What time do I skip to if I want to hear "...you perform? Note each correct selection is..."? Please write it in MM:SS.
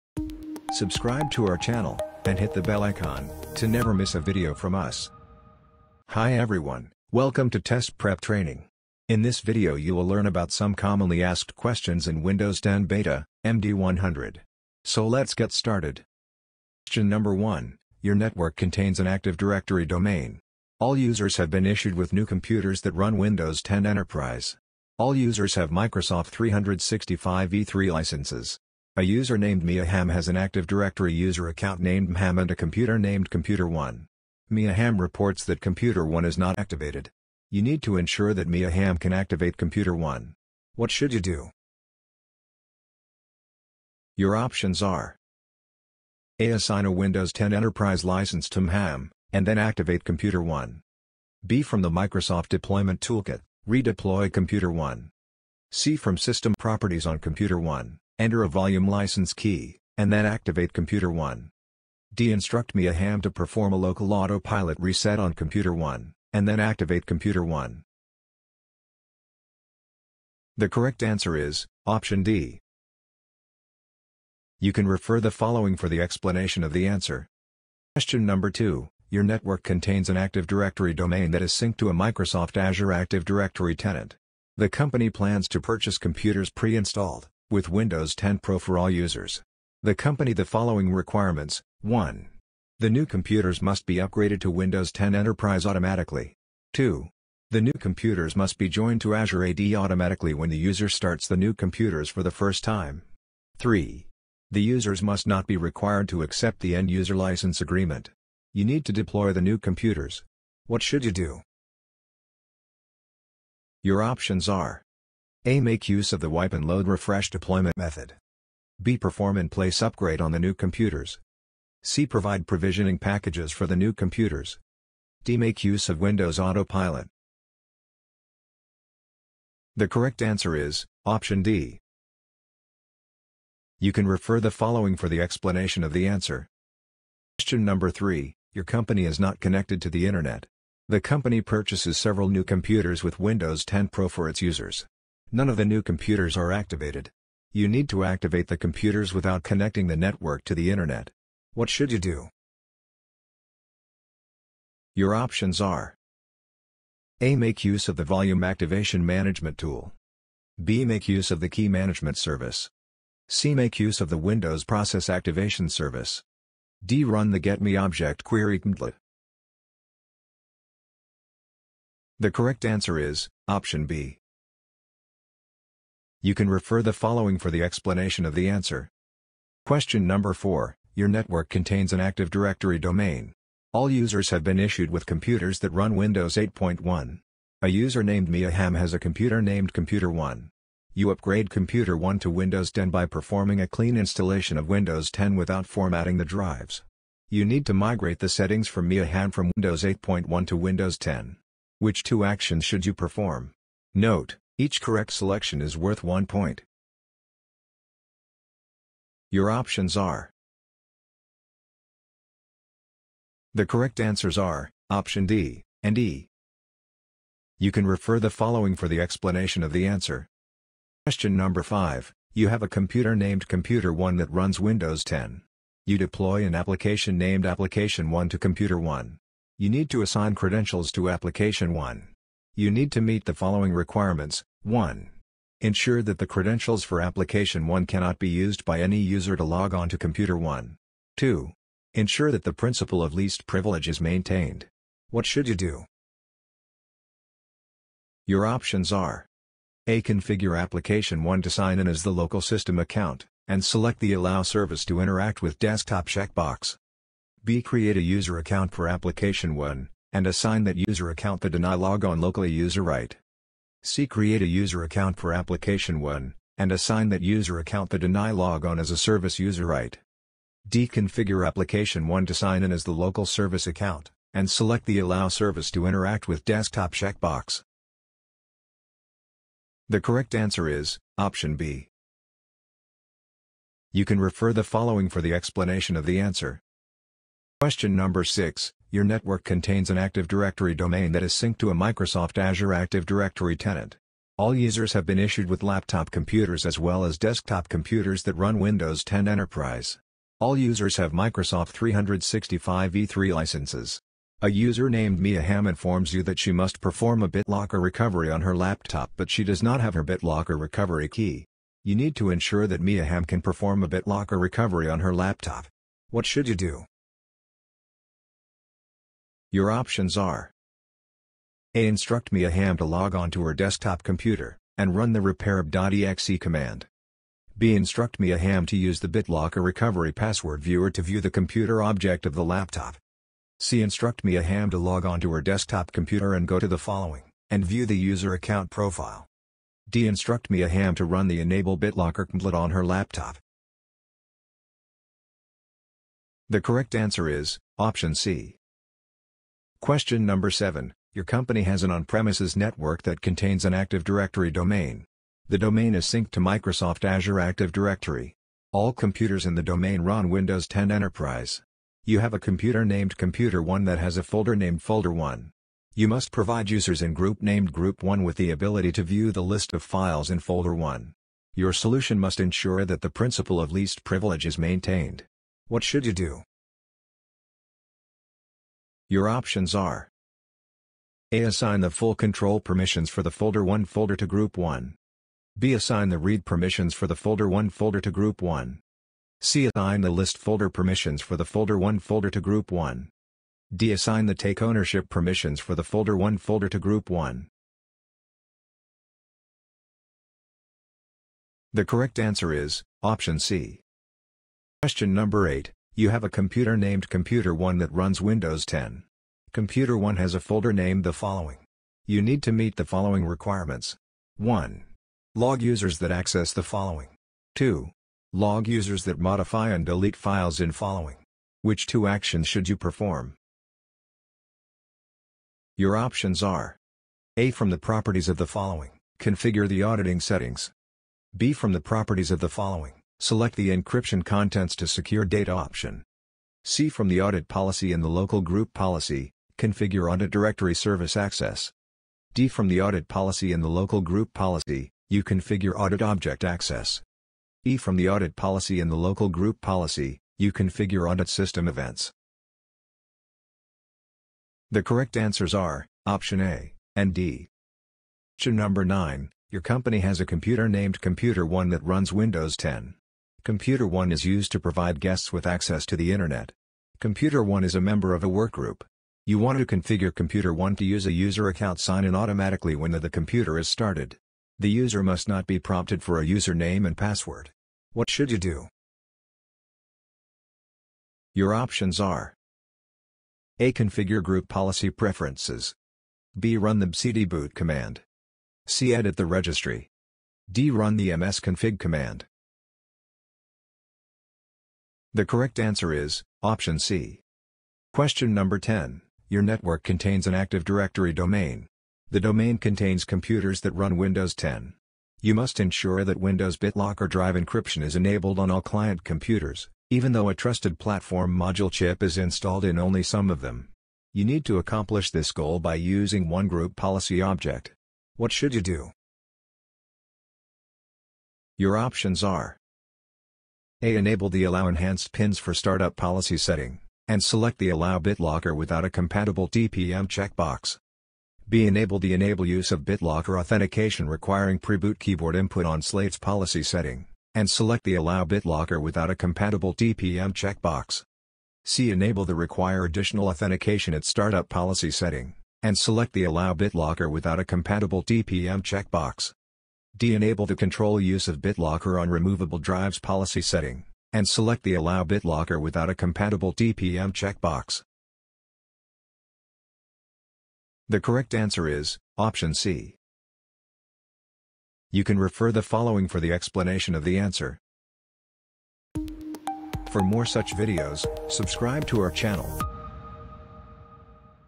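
03:22.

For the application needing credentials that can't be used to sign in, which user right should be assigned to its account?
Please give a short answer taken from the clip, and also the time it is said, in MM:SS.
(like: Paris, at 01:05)
deny logon locally, at 04:21.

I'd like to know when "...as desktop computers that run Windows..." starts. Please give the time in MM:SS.
04:57.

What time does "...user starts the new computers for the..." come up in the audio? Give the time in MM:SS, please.
01:40.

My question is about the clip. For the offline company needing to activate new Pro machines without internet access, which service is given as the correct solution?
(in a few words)
Key Management Service.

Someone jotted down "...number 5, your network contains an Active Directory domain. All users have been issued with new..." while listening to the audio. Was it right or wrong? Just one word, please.
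wrong.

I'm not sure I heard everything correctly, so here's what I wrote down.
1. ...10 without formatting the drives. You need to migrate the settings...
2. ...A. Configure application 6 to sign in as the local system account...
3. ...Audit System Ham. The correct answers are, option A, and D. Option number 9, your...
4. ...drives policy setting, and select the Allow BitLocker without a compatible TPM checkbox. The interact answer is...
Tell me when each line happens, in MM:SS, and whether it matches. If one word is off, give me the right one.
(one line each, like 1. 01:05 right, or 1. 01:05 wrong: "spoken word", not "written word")
1. 03:15 right
2. 04:09 wrong: "1", not "6"
3. 07:31 wrong: "Events", not "Ham"
4. 09:12 wrong: "correct", not "interact".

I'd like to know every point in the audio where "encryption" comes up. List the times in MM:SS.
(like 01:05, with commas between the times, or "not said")
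07:13, 08:27.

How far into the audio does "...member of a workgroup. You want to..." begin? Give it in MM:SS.
07:47.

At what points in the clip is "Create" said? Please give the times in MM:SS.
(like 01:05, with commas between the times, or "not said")
04:17, 04:24.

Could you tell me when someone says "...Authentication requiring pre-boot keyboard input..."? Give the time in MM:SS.
08:53.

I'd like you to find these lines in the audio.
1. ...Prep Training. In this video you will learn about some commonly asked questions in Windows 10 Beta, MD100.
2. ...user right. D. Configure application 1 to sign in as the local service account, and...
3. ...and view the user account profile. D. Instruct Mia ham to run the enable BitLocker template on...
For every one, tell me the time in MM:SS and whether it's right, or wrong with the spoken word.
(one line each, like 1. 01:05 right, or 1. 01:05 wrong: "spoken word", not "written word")
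1. 00:07 right
2. 04:29 right
3. 05:37 right.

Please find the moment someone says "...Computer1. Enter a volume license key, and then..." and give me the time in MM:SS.
00:57.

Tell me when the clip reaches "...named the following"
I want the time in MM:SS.
06:50.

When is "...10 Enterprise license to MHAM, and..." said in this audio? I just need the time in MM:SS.
00:47.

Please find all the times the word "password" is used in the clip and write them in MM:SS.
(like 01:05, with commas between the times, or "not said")
05:30, 07:56.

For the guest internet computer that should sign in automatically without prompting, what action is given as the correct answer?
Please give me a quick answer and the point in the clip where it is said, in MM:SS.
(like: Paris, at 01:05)
Edit the registry, at 08:08.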